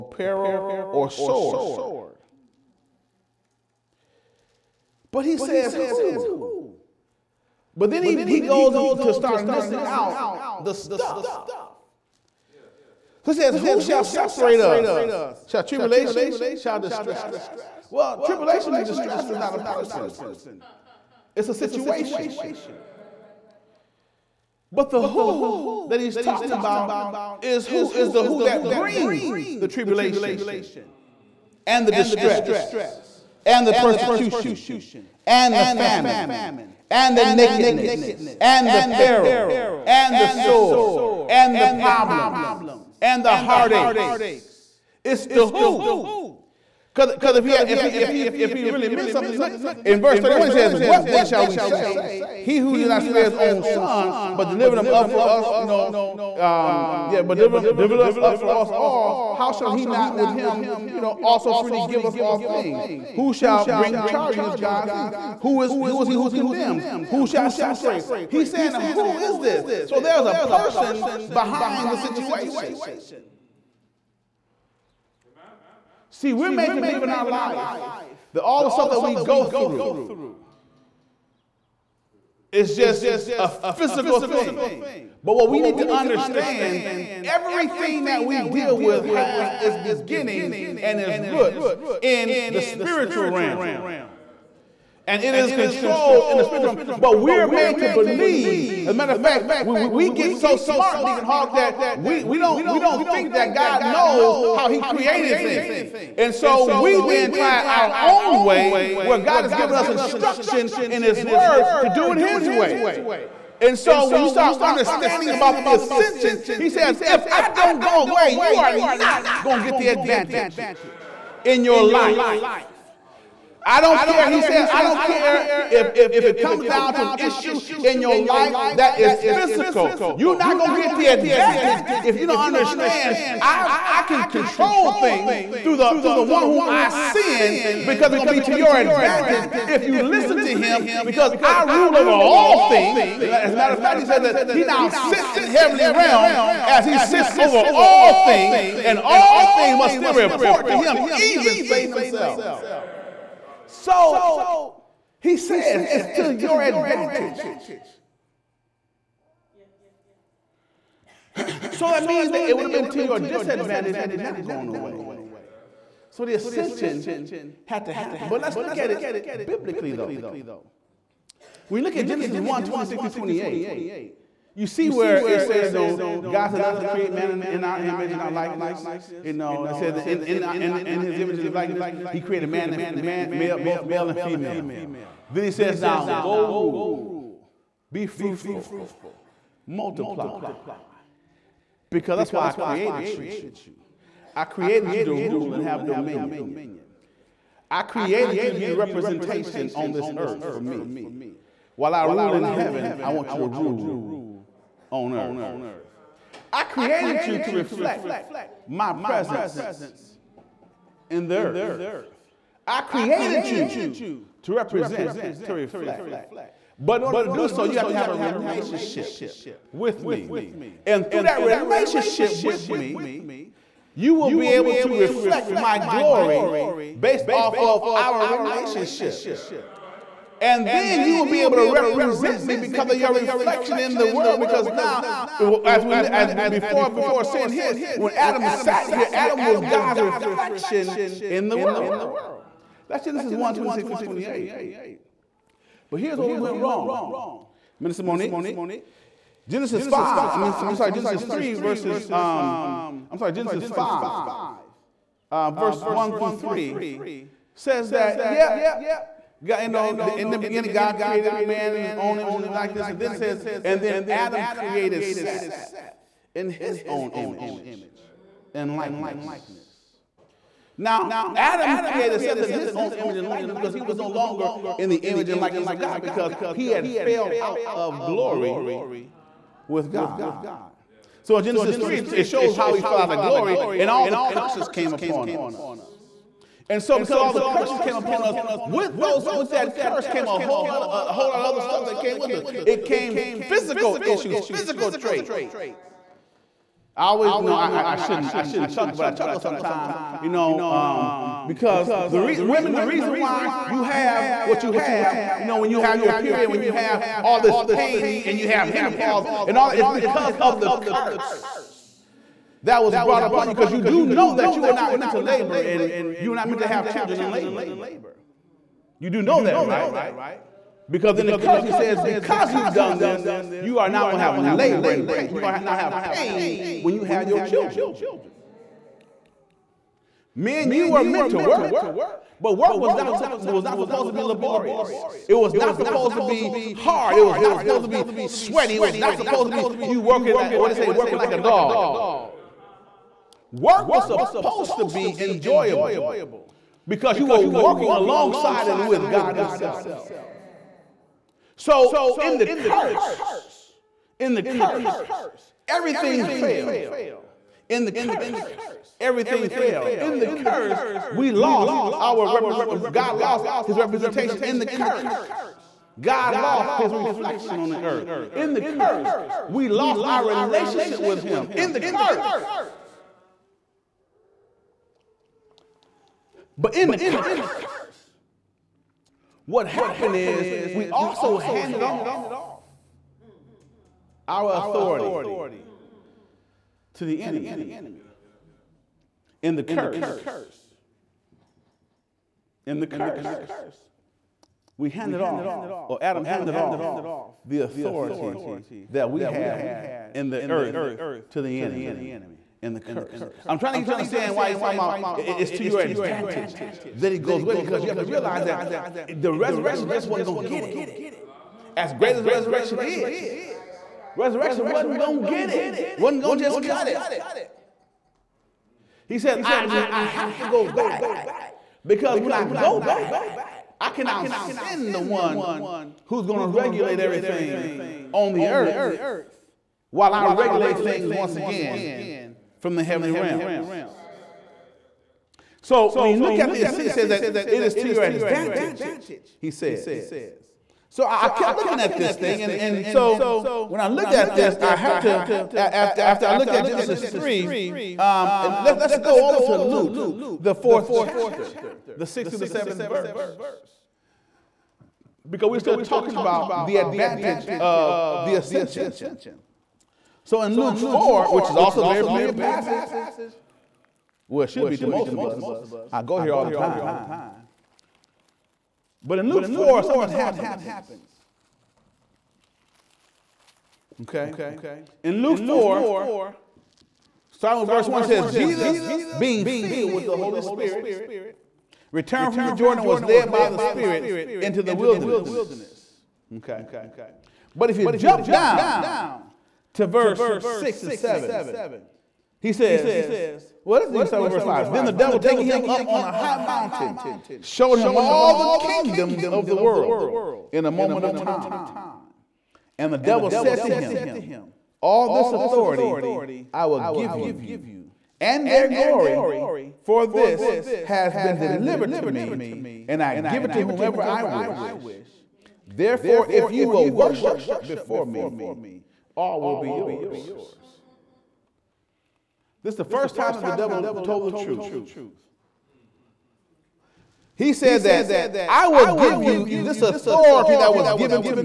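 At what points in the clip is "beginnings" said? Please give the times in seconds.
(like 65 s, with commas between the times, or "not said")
89 s, 260 s.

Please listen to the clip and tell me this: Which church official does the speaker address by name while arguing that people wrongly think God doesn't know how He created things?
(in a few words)
Deacon Hawk.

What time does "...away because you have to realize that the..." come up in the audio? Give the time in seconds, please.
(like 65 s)
407 s.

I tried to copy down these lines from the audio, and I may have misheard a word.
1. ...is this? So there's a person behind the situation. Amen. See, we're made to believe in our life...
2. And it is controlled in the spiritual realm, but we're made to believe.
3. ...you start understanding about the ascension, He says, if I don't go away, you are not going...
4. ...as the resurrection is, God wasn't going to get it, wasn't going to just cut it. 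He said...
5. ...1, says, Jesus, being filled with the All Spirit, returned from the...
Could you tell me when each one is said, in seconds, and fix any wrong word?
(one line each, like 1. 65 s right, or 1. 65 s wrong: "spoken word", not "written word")
1. 69 s right
2. 95 s right
3. 114 s right
4. 412 s wrong: "Resurrection", not "God"
5. 477 s wrong: "Holy", not "All".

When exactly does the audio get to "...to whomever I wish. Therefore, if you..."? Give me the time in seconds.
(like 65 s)
513 s.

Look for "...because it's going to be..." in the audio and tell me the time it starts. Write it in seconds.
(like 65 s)
137 s.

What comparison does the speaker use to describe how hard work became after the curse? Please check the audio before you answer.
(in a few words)
working like a dog.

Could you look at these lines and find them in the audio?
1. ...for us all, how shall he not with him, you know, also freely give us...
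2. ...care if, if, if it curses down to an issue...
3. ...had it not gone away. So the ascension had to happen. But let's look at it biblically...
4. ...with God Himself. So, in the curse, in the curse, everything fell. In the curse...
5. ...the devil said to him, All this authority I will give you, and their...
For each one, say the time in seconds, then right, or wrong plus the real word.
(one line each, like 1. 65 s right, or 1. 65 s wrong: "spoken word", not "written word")
1. 58 s right
2. 125 s wrong: "comes", not "curses"
3. 163 s right
4. 348 s right
5. 502 s right.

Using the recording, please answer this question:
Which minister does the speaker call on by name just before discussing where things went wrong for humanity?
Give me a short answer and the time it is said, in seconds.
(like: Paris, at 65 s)
Minister Monique, at 247 s.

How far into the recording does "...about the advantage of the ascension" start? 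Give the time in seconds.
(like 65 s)
456 s.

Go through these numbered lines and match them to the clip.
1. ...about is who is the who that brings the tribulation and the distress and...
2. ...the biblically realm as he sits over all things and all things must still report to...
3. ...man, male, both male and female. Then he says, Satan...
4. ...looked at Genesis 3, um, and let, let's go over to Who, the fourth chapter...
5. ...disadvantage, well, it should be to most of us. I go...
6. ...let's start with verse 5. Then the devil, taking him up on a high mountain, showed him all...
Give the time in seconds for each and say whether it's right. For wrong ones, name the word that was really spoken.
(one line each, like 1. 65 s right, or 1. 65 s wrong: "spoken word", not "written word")
1. 26 s right
2. 145 s wrong: "heavenly", not "biblically"
3. 182 s wrong: "Now", not "Satan"
4. 446 s wrong: "Luke", not "Who"
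5. 462 s wrong: "passage", not "disadvantage"
6. 493 s right.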